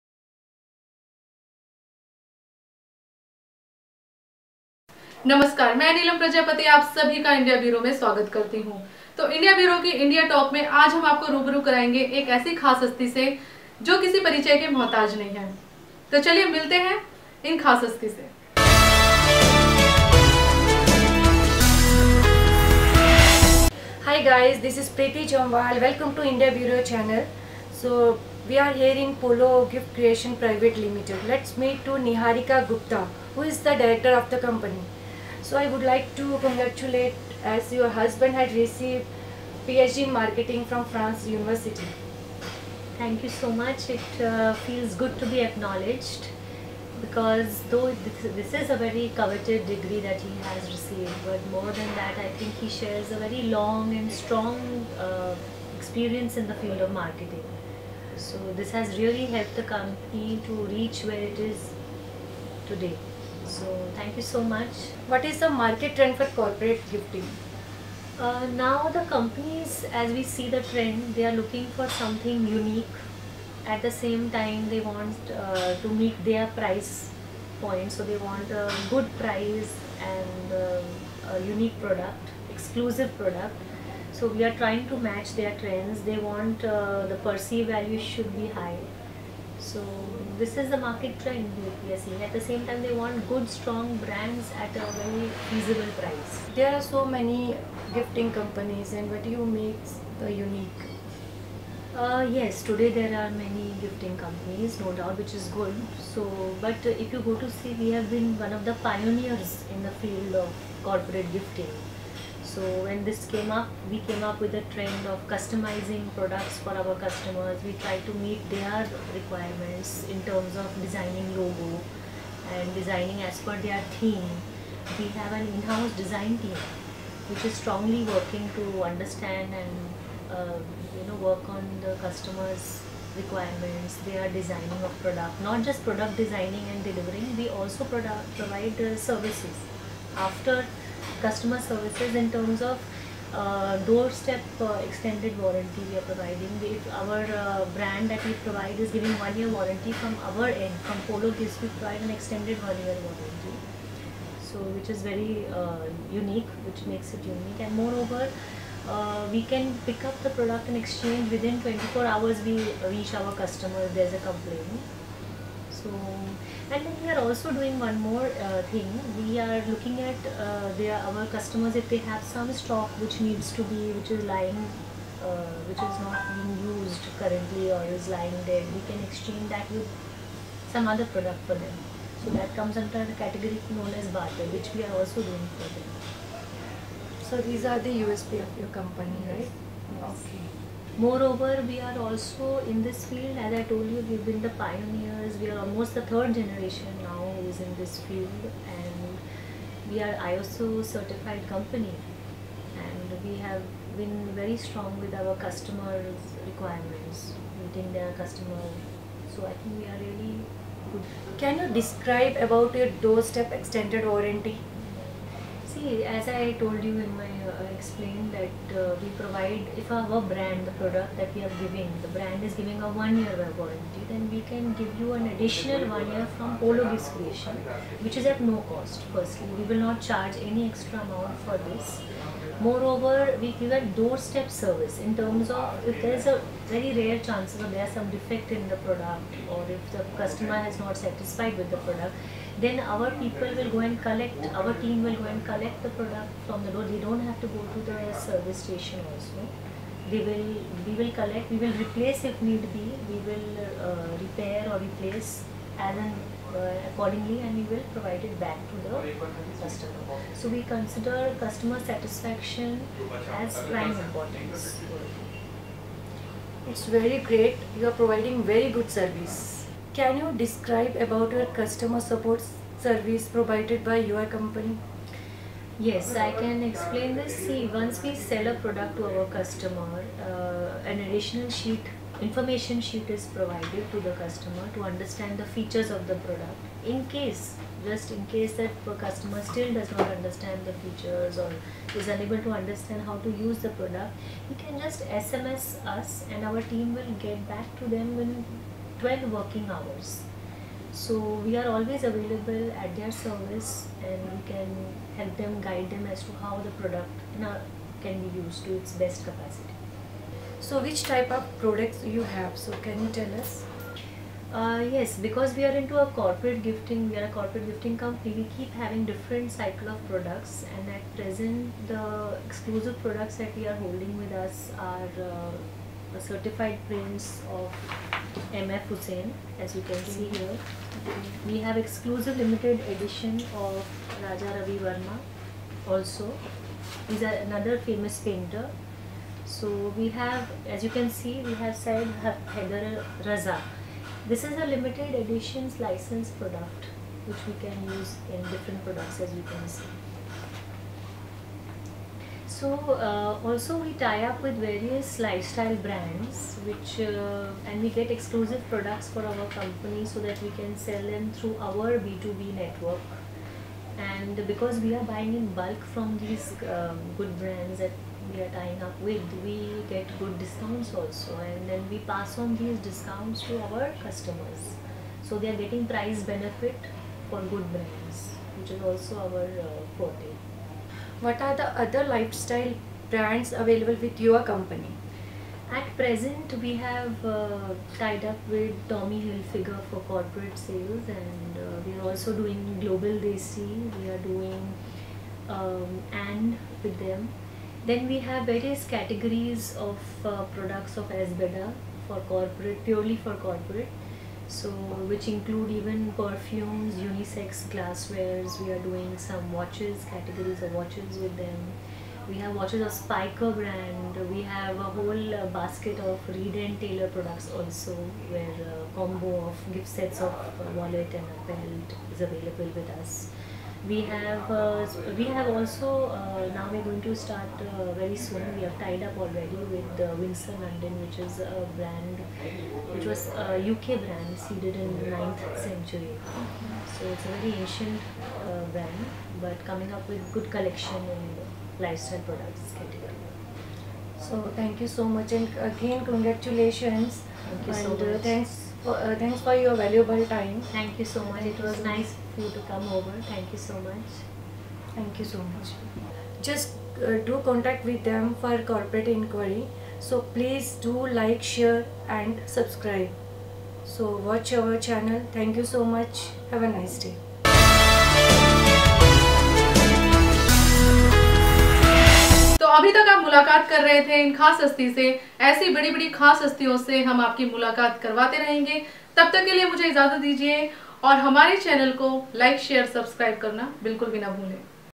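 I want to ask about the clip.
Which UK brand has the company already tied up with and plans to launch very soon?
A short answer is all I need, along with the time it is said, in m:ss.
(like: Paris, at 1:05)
Windsor London, at 7:10.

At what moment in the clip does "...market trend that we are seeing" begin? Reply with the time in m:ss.
1:30.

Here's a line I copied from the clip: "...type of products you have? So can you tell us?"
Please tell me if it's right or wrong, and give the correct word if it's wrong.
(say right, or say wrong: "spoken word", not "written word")
right.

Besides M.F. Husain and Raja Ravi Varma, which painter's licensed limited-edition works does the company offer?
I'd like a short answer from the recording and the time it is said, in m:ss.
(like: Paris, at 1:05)
Syed Haider Raza, at 5:41.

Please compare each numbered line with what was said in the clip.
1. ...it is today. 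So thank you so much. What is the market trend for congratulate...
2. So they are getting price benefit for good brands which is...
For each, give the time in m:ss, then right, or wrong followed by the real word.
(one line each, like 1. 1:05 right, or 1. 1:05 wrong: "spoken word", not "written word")
1. 1:01 wrong: "corporate", not "congratulate"
2. 6:15 right.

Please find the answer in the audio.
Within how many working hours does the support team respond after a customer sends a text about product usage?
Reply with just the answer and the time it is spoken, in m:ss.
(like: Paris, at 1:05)
12, at 4:58.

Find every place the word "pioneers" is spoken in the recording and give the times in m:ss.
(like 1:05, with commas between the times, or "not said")
1:48, 3:14.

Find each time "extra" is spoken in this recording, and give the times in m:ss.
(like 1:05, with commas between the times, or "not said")
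3:50.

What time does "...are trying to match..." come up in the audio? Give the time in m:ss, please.
1:24.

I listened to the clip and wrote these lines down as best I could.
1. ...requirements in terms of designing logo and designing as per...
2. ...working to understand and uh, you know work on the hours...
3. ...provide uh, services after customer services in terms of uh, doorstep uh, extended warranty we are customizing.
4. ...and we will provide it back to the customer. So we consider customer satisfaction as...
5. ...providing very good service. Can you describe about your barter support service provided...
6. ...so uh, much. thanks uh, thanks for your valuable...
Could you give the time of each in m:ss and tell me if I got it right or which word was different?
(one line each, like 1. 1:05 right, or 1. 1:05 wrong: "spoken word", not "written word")
1. 1:59 right
2. 2:08 wrong: "customers", not "hours"
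3. 2:18 wrong: "providing", not "customizing"
4. 4:17 right
5. 4:27 wrong: "customer", not "barter"
6. 7:27 right.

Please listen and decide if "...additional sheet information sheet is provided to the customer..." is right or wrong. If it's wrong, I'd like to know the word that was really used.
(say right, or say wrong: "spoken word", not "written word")
right.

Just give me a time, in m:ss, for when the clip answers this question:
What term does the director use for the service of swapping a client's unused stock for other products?
3:04.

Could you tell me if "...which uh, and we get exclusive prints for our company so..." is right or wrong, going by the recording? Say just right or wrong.
wrong.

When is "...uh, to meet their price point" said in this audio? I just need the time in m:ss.
1:15.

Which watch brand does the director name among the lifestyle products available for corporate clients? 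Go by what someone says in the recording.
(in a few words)
Spiker.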